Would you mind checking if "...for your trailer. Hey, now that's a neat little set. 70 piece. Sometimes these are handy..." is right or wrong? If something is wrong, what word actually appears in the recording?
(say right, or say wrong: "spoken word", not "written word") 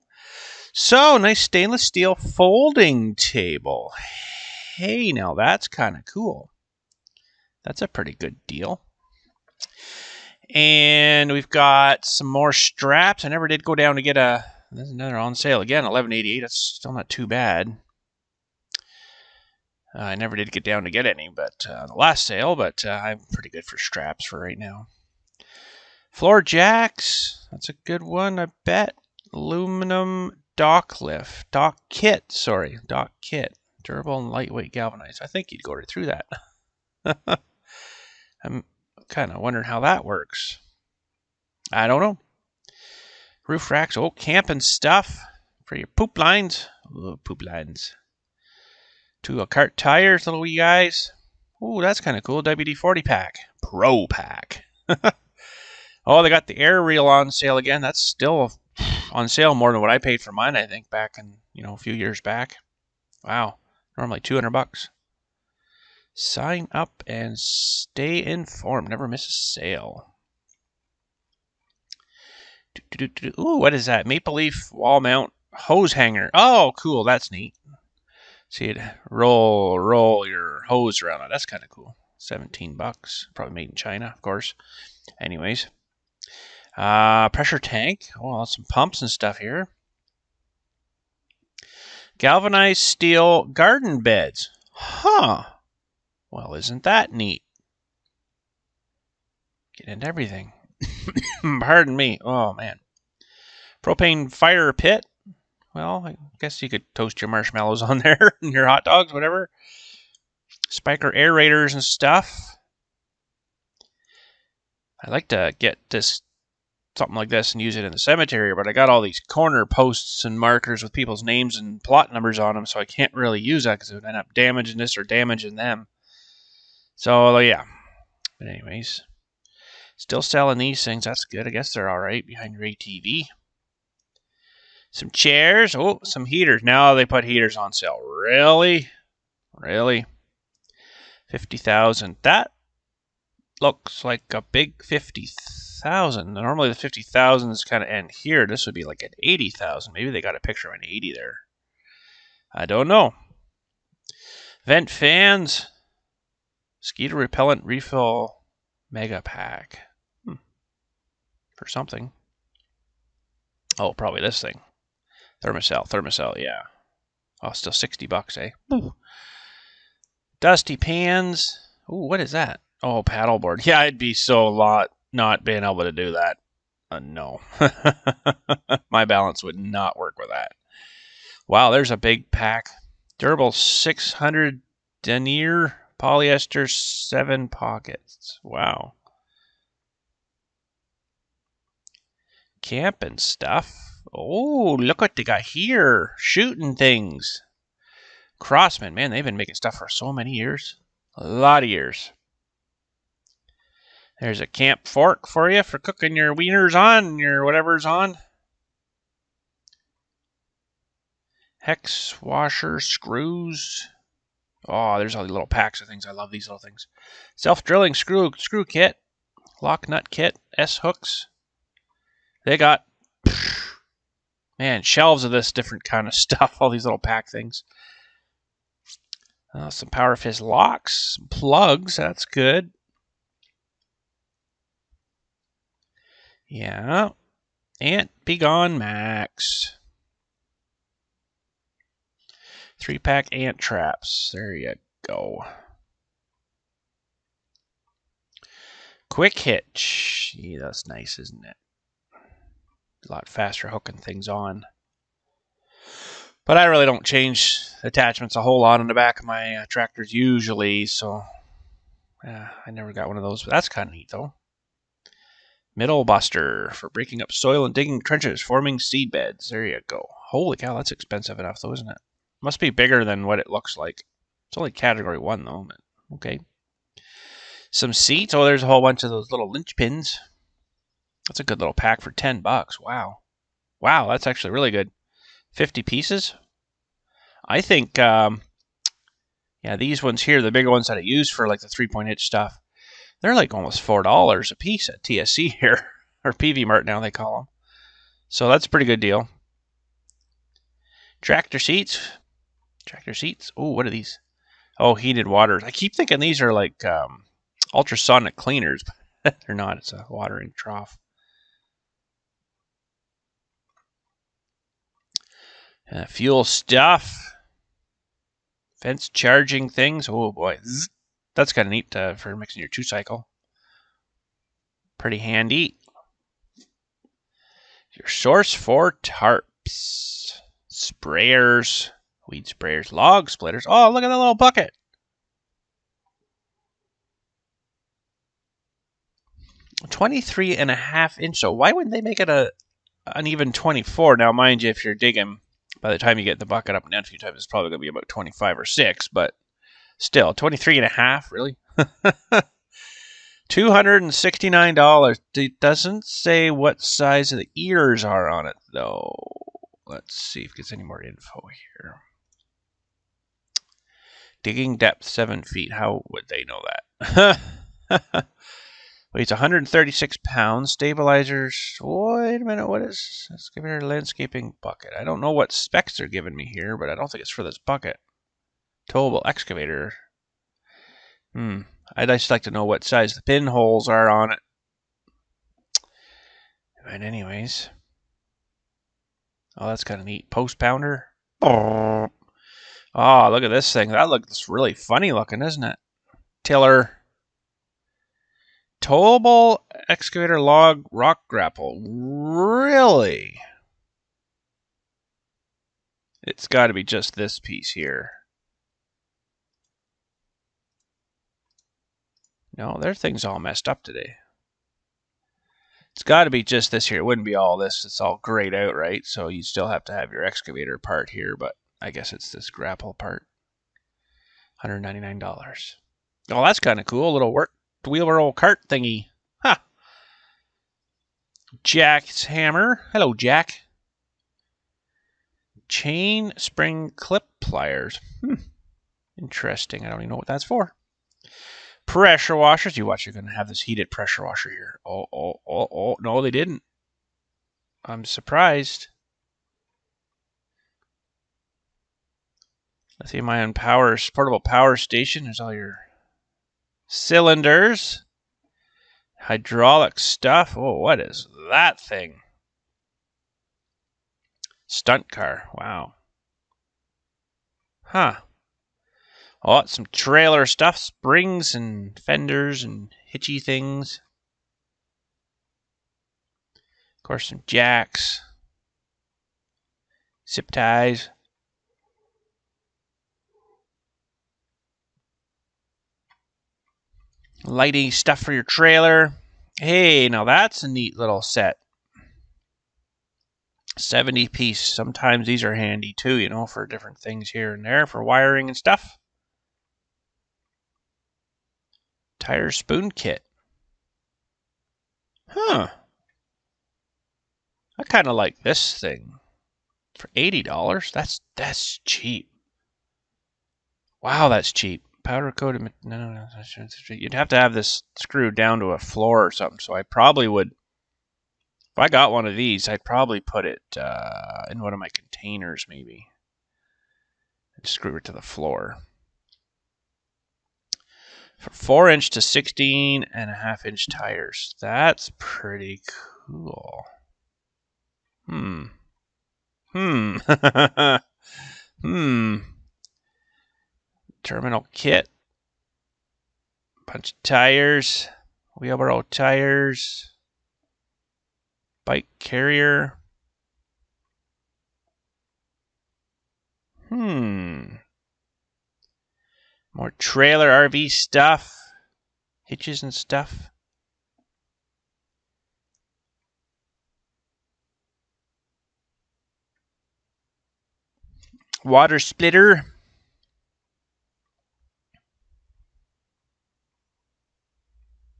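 right.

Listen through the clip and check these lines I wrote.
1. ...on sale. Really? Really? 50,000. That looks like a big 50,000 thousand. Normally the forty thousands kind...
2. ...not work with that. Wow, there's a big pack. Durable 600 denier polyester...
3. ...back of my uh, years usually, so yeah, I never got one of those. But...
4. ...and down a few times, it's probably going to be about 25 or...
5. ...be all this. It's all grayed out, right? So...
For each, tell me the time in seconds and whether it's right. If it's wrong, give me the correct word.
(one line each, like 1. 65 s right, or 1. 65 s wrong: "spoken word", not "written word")
1. 137 s wrong: "fifty", not "forty"
2. 179 s right
3. 258 s wrong: "tractors", not "years"
4. 346 s right
5. 417 s right.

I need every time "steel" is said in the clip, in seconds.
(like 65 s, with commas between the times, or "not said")
1 s, 92 s.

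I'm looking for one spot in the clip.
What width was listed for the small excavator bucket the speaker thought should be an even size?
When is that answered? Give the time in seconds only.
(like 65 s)
339 s.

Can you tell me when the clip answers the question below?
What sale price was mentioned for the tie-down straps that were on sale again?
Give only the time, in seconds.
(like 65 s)
15 s.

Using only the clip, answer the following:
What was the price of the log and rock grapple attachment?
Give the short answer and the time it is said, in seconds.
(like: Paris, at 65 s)
$199, at 424 s.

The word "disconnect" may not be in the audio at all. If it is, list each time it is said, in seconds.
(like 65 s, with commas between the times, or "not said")
not said.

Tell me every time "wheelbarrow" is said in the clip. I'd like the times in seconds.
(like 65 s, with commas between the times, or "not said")
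427 s, 548 s.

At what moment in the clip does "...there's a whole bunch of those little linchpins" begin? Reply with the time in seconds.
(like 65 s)
278 s.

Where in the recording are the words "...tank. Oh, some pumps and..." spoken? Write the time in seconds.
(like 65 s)
87 s.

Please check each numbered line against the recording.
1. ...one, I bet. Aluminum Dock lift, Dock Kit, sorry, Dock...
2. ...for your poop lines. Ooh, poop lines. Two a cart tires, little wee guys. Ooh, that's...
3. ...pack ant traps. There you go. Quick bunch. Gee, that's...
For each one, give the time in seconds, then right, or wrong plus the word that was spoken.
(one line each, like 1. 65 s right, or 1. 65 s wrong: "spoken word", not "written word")
1. 28 s right
2. 45 s right
3. 242 s wrong: "hitch", not "bunch".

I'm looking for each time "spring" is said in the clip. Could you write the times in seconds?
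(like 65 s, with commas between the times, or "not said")
436 s, 470 s.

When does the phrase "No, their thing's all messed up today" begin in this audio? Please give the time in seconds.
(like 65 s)
412 s.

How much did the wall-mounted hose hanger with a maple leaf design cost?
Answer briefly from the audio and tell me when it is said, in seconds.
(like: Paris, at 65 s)
17 bucks, at 82 s.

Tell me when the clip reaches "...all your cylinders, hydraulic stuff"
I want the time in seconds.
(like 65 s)
455 s.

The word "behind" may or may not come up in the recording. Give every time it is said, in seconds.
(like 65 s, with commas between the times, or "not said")
132 s.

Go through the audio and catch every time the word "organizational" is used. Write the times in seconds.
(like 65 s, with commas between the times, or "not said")
not said.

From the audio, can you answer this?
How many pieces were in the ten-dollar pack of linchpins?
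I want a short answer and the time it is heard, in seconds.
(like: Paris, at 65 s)
50, at 285 s.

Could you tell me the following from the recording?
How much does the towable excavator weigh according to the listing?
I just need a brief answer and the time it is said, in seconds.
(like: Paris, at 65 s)
136 pounds, at 369 s.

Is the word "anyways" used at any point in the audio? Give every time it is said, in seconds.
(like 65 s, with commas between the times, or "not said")
85 s, 128 s, 387 s.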